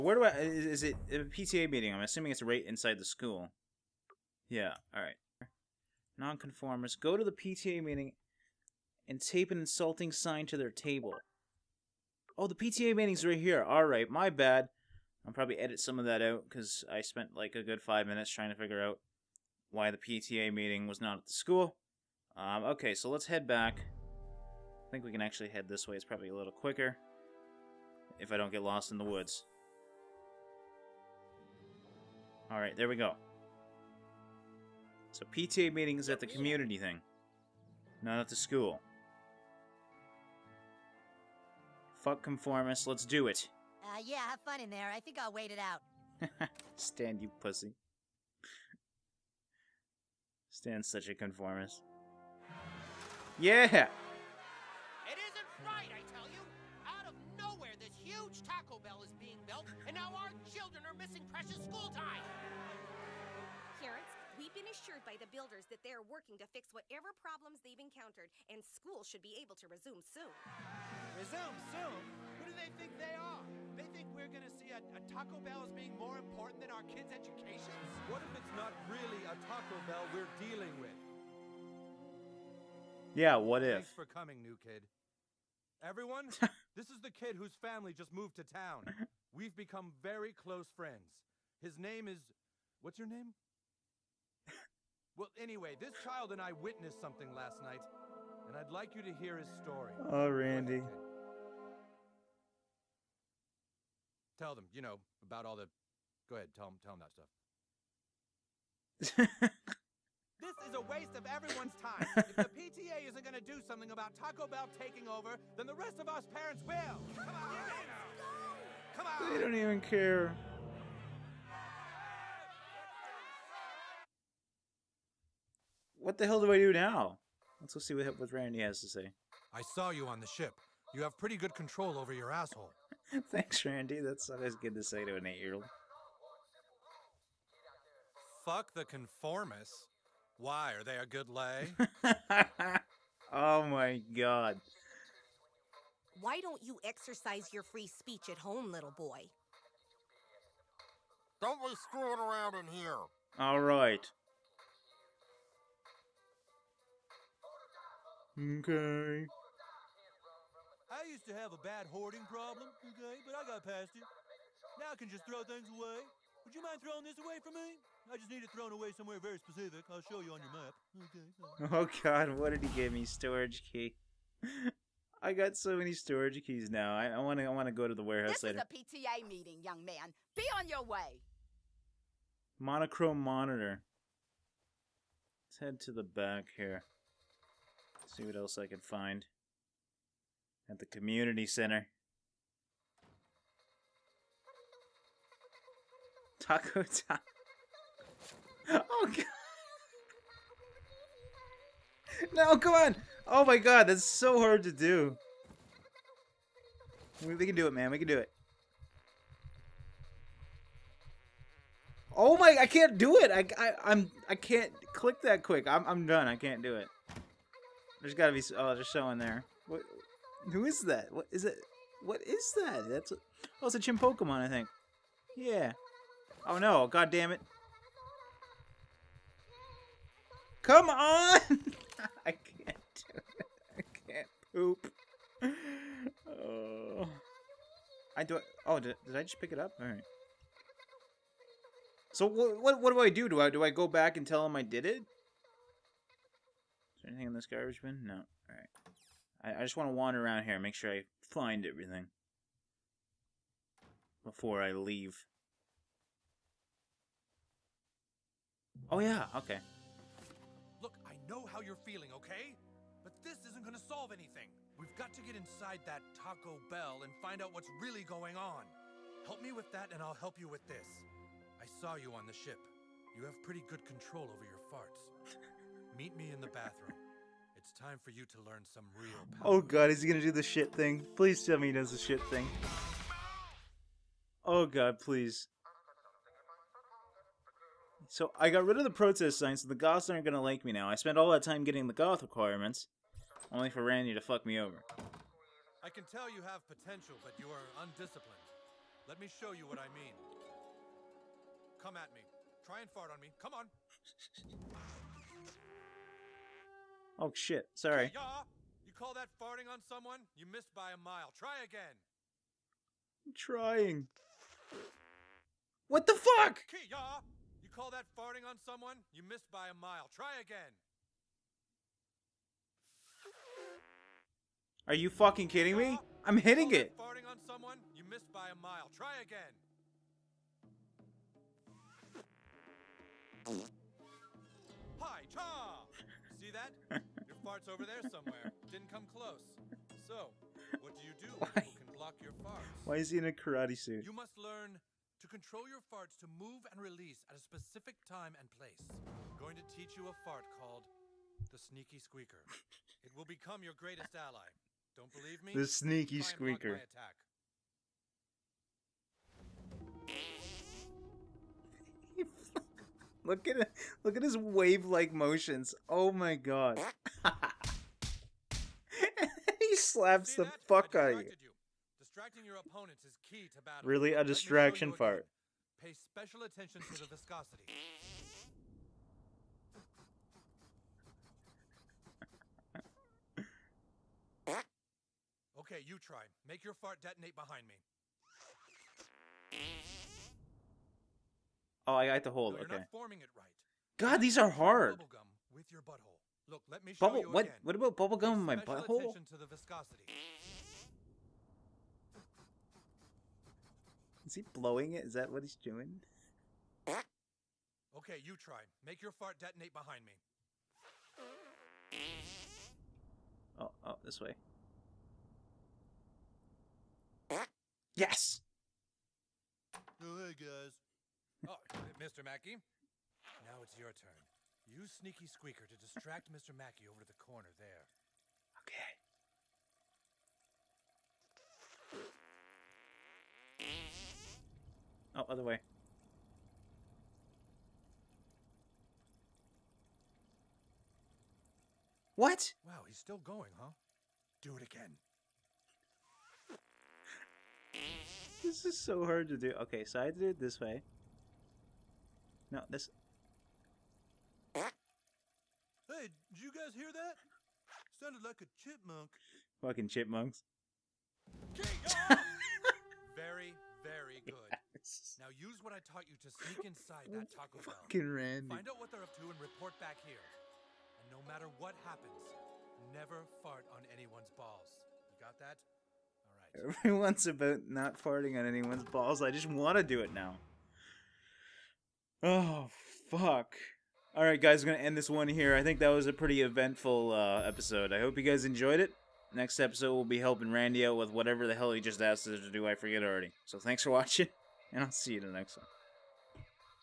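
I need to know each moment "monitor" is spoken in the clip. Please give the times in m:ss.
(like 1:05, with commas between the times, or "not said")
3:03.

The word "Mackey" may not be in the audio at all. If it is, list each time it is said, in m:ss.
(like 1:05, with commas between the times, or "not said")
7:02, 7:06.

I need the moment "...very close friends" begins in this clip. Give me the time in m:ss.
1:30.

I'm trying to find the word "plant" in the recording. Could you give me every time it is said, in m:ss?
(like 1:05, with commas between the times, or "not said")
not said.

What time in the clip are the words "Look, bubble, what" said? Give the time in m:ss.
6:36.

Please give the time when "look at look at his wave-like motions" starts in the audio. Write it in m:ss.
6:03.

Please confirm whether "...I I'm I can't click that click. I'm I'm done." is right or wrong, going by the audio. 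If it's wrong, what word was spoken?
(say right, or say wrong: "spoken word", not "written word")
wrong: "quick", not "click".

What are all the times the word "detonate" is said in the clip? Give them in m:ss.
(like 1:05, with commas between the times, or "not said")
6:27, 6:49.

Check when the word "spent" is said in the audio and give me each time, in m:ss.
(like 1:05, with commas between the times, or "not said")
0:16, 4:50.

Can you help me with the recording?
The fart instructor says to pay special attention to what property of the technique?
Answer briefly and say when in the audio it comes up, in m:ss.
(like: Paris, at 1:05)
Viscosity, at 6:17.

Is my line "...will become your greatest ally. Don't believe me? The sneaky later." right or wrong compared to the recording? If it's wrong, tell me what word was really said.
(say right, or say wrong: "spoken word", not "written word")
wrong: "squeaker", not "later".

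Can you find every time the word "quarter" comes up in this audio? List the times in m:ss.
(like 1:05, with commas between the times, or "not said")
not said.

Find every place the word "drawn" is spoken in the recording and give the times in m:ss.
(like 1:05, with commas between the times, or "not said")
not said.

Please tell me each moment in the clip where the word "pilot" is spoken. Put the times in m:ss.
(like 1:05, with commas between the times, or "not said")
not said.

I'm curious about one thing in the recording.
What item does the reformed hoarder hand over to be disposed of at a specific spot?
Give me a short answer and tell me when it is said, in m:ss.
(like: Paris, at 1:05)
Storage key, at 2:53.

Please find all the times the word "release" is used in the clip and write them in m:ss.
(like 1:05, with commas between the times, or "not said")
5:46.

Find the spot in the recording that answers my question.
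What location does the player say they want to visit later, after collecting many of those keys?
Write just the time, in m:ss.
2:58.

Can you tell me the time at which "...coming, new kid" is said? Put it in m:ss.
1:24.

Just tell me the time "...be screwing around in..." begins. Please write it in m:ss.
2:31.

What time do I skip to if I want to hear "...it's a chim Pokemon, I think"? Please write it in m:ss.
3:43.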